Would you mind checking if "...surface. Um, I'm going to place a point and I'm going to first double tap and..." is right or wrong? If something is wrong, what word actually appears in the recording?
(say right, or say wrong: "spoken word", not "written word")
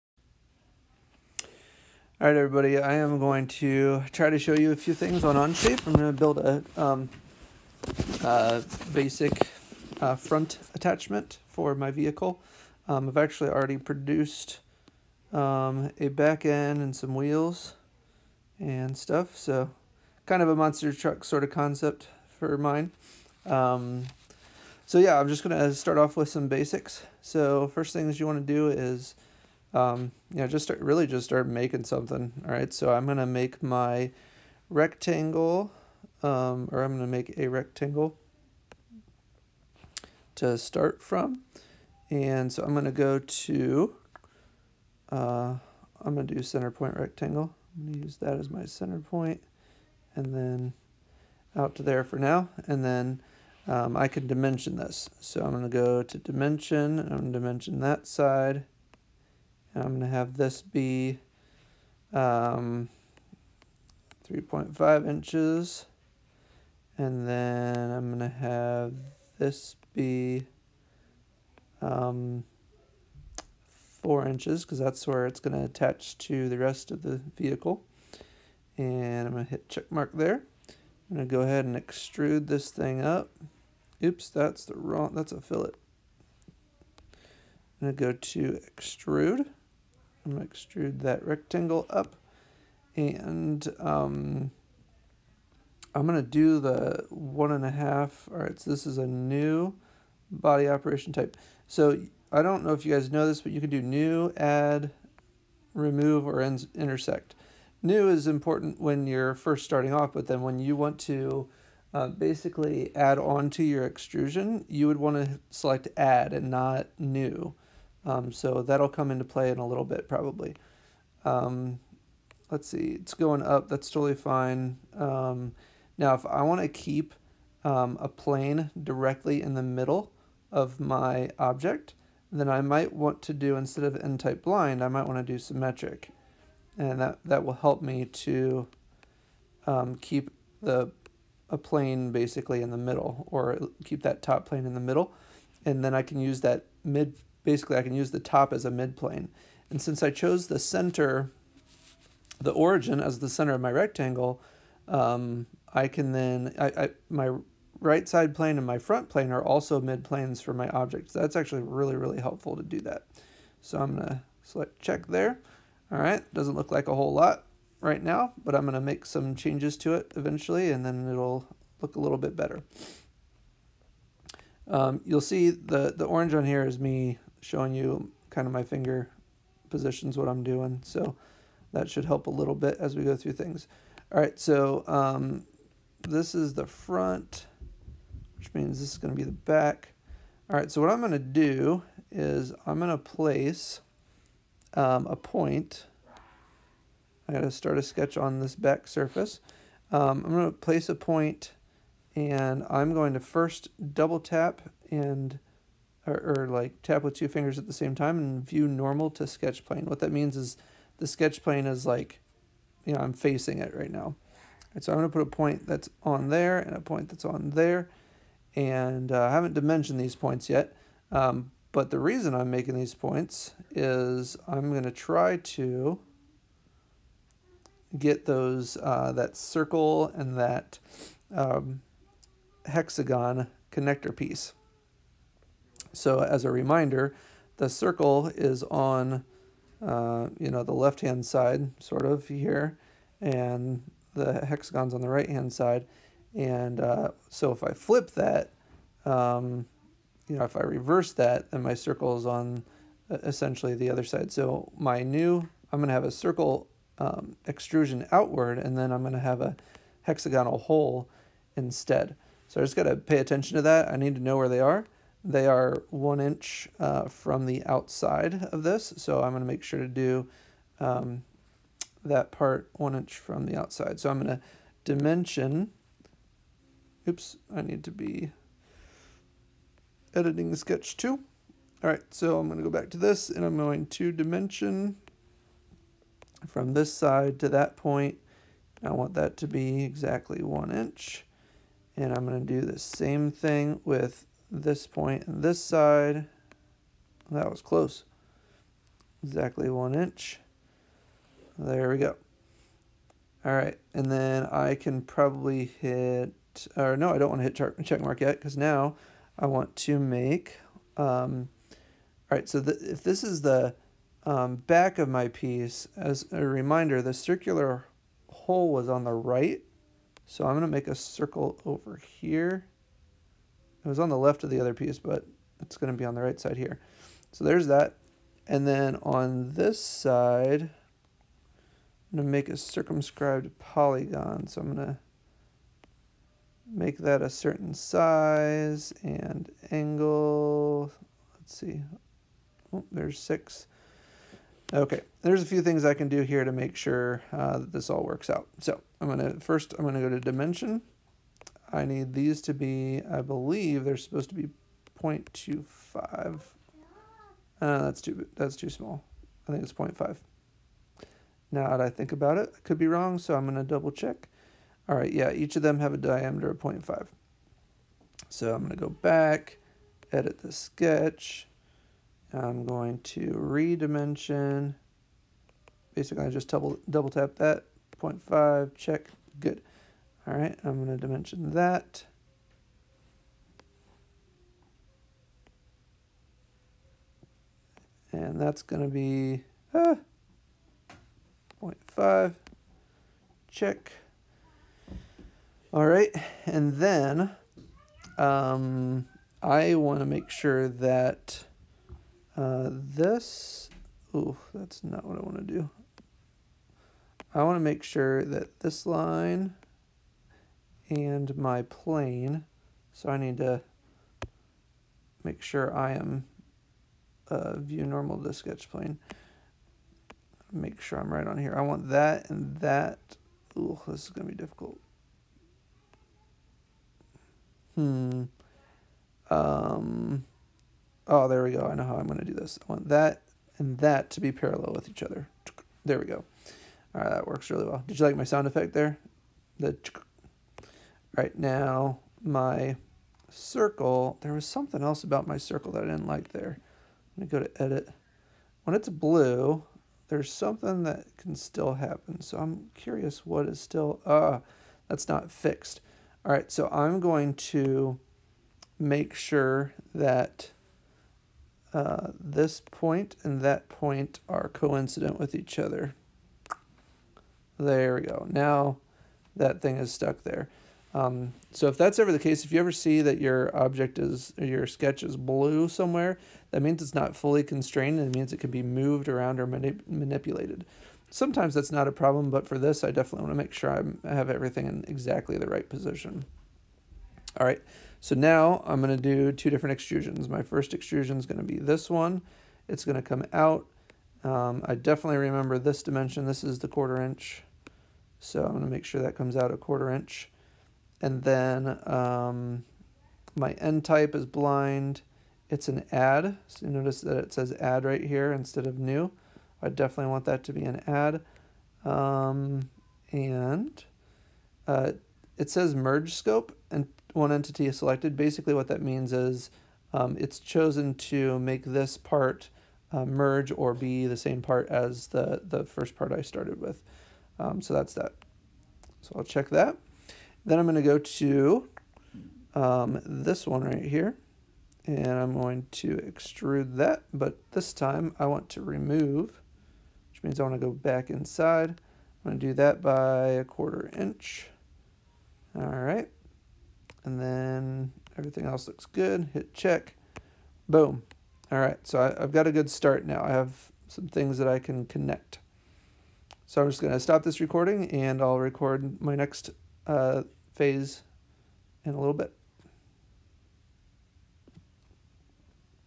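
right.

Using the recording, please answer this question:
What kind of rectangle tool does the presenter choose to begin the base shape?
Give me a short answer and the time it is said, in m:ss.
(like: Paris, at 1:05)
center point rectangle, at 0:46.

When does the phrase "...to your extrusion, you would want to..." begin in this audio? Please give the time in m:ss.
1:53.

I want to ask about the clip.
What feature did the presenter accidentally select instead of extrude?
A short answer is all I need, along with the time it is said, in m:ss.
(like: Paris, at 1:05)
fillet, at 1:25.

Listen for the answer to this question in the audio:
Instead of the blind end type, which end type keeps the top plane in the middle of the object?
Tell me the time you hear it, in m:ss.
2:15.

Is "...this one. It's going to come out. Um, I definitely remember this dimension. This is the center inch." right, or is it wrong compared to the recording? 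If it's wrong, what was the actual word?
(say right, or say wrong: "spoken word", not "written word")
wrong: "quarter", not "center".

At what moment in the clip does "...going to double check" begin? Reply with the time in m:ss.
6:03.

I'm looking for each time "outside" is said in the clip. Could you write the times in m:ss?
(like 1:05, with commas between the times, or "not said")
4:27, 4:33.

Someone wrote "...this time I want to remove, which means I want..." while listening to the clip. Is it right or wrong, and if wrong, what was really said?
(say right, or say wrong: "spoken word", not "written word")
right.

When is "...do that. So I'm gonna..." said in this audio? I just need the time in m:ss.
2:42.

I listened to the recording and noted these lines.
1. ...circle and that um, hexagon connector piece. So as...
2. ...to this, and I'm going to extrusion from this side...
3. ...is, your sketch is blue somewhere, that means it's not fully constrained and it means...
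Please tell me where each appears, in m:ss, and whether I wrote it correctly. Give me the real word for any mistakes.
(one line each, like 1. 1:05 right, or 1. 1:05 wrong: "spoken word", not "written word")
1. 3:49 right
2. 4:42 wrong: "dimension", not "extrusion"
3. 7:53 right.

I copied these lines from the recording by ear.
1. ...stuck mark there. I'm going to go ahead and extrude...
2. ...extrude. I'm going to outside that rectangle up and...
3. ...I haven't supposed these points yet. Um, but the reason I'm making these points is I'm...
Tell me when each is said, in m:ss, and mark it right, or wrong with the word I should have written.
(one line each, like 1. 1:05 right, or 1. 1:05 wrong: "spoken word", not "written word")
1. 1:19 wrong: "check", not "stuck"
2. 1:28 wrong: "extrude", not "outside"
3. 3:39 wrong: "dimensioned", not "supposed".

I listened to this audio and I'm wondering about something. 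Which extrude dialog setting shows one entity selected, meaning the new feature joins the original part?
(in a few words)
merge scope.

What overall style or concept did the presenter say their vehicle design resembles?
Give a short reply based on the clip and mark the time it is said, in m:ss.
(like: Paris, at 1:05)
monster truck, at 0:20.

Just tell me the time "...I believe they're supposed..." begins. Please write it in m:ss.
5:53.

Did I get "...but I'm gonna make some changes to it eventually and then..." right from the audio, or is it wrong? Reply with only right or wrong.
right.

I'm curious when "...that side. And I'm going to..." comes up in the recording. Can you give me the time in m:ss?
0:57.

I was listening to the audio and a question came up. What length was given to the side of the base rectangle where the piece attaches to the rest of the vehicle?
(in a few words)
4 inches.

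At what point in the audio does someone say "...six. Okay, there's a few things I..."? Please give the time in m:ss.
5:43.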